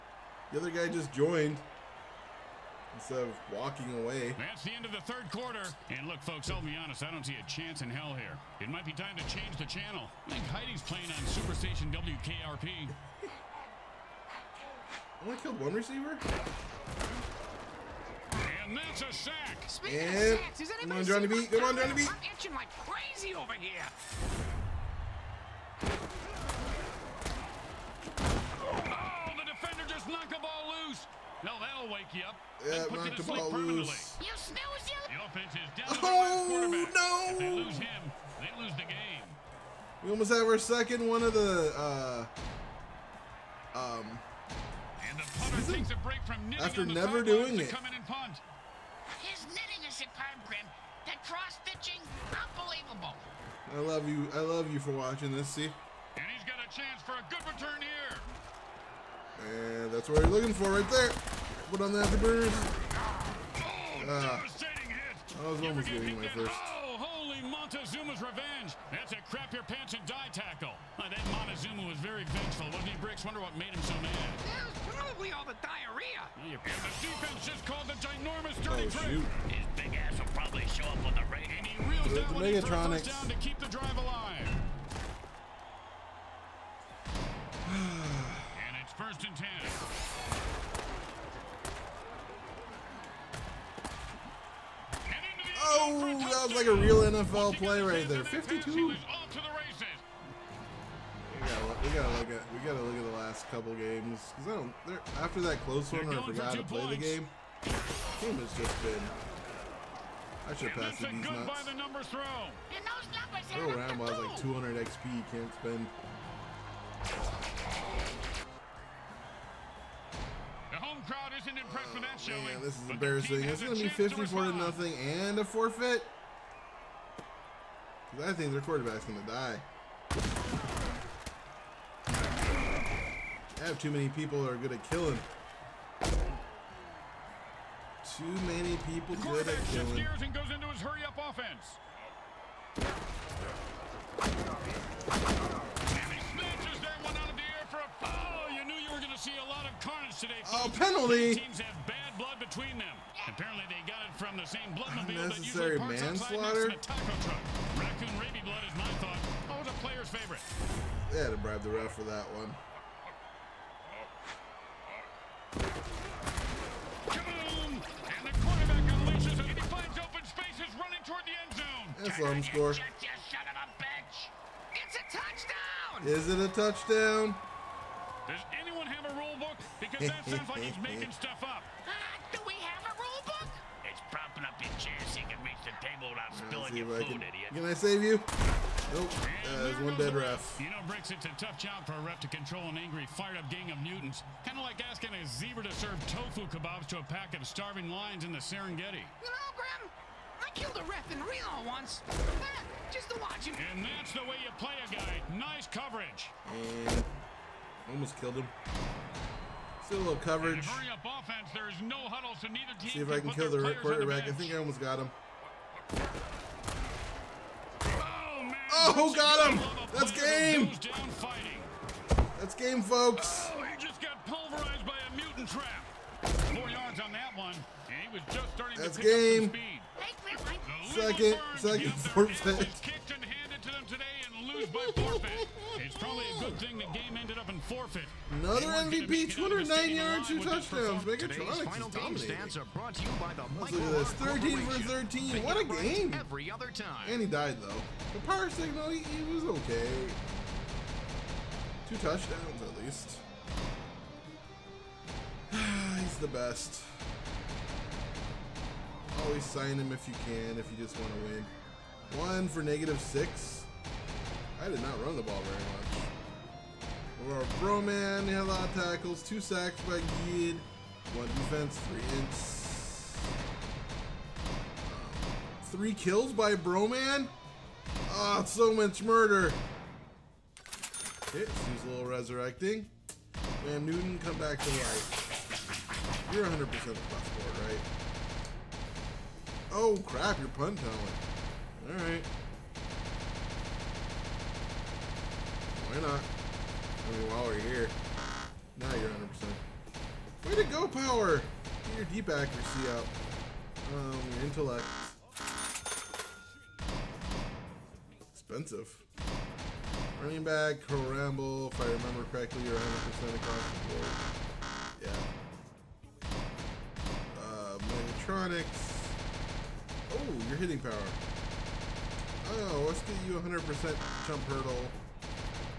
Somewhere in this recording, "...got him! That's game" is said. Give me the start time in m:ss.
3:39.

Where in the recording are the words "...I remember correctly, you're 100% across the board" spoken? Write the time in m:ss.
5:11.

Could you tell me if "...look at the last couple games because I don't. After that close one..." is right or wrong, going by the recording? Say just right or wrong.
right.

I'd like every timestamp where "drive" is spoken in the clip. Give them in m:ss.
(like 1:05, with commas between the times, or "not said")
1:23.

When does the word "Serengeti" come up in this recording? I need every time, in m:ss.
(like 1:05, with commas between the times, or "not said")
3:18.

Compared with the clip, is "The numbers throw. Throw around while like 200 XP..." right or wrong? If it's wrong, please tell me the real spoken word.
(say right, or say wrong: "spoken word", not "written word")
right.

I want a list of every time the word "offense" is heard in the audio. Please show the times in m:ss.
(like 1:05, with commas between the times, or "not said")
0:35, 2:21, 3:30.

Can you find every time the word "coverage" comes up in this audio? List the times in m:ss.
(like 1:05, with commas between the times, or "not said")
3:25, 3:30.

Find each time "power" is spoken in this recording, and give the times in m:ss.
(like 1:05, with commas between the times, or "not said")
4:08, 5:00, 5:20.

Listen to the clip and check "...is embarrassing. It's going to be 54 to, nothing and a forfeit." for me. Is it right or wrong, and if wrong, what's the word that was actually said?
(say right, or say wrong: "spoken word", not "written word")
right.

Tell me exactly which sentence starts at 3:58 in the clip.
Another MVP, 209 yards, two touchdowns.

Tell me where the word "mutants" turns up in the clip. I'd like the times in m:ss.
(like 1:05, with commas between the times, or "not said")
3:13, 3:45.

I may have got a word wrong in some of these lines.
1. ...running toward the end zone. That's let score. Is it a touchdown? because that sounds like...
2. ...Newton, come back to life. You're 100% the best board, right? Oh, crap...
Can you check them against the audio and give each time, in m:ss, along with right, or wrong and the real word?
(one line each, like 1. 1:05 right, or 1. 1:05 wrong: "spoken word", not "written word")
1. 2:50 right
2. 4:43 right.